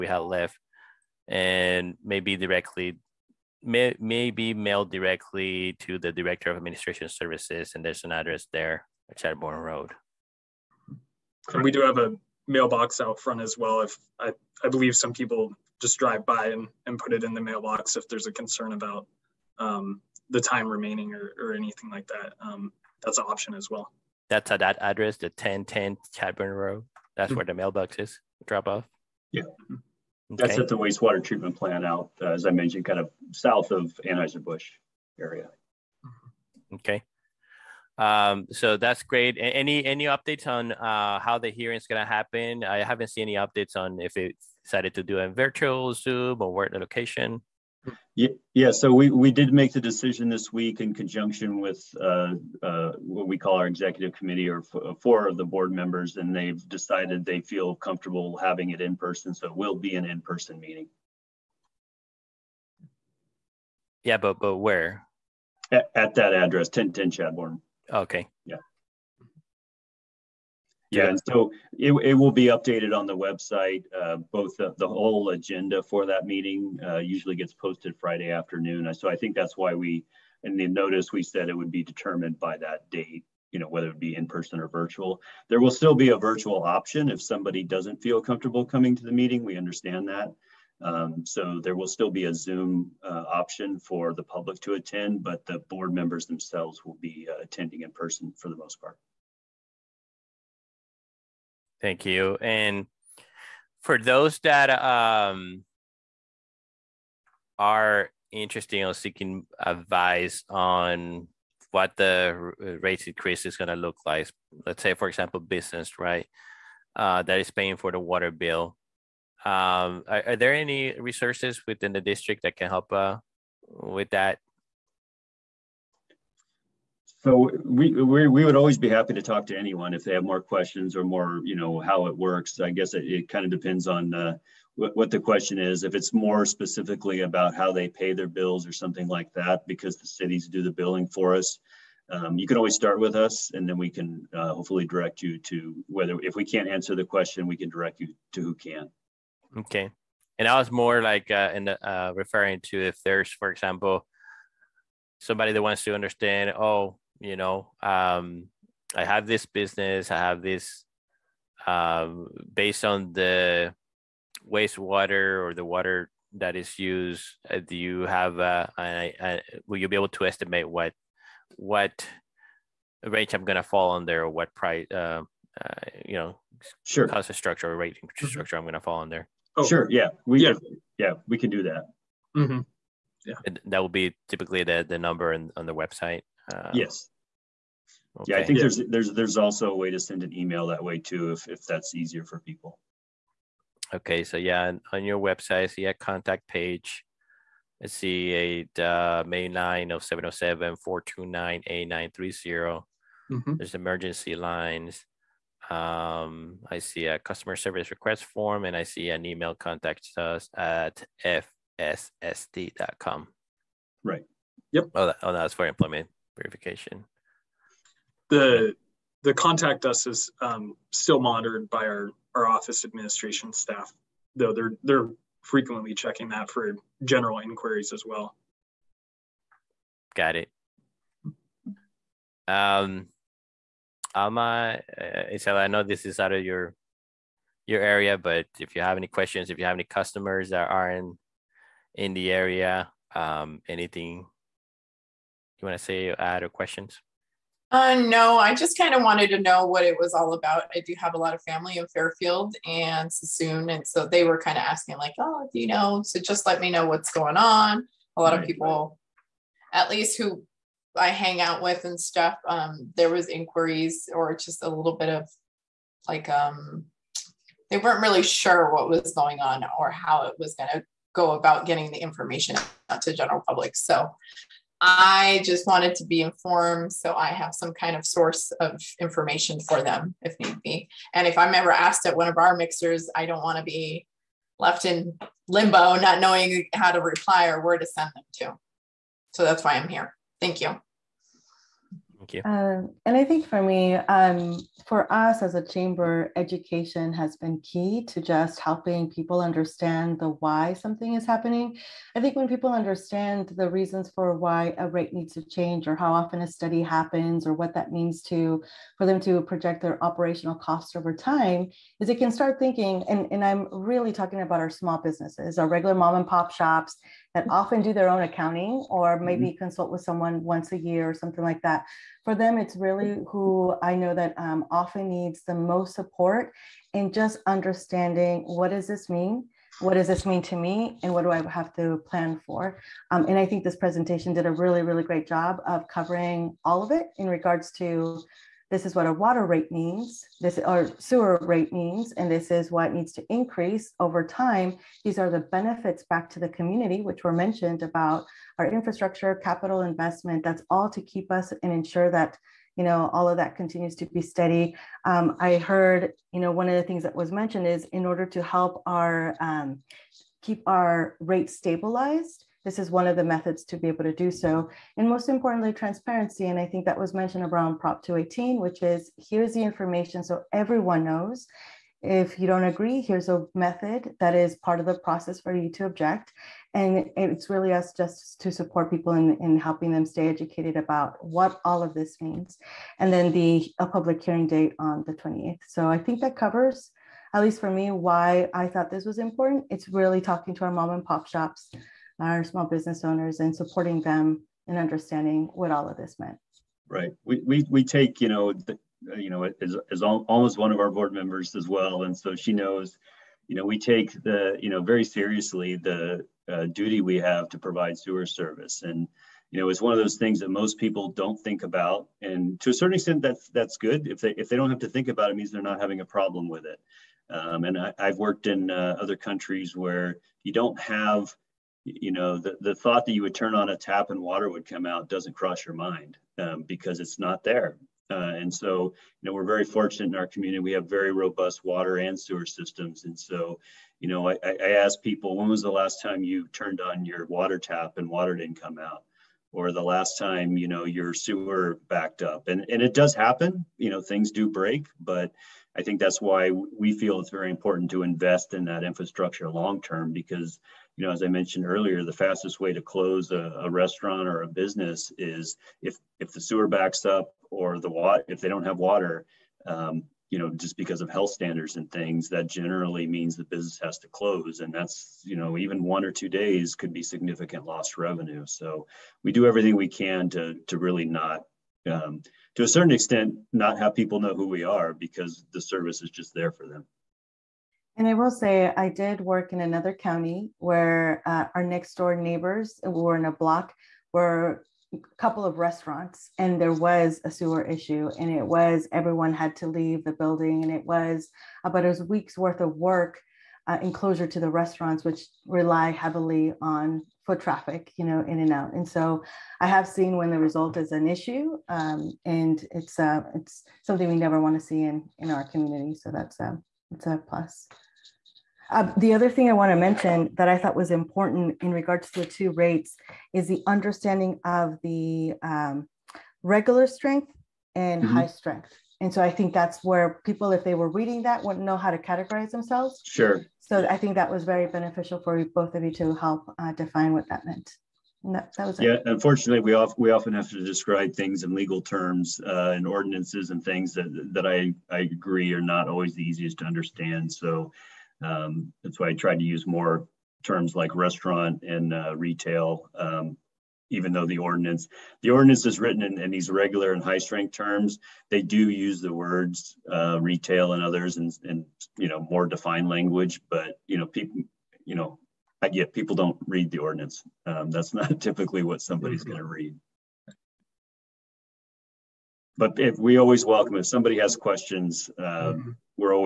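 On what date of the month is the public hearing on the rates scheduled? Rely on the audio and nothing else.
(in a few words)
the 28th.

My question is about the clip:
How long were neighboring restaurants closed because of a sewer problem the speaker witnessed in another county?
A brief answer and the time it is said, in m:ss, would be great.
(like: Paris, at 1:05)
a week, at 8:11.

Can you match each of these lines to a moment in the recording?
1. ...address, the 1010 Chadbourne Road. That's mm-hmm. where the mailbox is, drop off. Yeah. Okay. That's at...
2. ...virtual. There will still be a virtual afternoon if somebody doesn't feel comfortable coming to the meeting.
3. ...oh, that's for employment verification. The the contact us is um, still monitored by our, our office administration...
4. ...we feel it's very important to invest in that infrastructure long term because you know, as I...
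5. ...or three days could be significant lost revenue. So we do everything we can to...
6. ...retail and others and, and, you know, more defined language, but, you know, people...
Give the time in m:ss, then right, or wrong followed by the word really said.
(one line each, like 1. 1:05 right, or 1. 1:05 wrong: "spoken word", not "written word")
1. 0:24 right
2. 1:24 wrong: "option", not "afternoon"
3. 3:35 right
4. 7:26 right
5. 7:46 wrong: "two", not "three"
6. 9:10 right.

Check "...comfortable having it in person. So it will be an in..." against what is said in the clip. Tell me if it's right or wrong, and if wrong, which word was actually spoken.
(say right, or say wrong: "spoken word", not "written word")
right.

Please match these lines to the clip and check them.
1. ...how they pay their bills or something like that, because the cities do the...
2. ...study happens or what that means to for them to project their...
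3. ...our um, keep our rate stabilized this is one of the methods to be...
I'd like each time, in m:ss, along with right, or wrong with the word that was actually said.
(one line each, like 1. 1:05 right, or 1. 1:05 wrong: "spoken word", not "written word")
1. 2:17 right
2. 5:06 right
3. 5:58 right.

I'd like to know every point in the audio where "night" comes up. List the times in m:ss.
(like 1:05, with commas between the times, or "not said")
not said.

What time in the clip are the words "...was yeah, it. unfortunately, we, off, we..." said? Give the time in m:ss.
8:48.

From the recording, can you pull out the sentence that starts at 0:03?
May, may be mailed directly to the director of administration services and there's an address there at Chadbourne Road.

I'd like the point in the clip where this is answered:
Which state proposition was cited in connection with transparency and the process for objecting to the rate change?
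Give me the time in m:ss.
6:07.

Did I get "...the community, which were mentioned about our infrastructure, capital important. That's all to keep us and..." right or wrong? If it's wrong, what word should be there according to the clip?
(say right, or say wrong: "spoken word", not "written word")
wrong: "investment", not "important".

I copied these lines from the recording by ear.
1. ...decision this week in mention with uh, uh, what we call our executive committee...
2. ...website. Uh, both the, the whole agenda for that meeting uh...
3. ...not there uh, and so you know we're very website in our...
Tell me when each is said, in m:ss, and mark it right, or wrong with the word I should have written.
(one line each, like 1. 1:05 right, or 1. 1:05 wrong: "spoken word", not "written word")
1. 0:49 wrong: "conjunction", not "mention"
2. 1:13 right
3. 7:07 wrong: "fortunate", not "website".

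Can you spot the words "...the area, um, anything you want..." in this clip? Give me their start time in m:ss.
4:02.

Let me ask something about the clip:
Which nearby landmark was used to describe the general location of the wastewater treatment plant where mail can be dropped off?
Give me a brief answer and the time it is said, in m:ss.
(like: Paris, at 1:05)
Anheuser-Busch, at 0:34.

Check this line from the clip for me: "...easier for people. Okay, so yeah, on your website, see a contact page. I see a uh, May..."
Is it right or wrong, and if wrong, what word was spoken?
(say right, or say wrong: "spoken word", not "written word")
right.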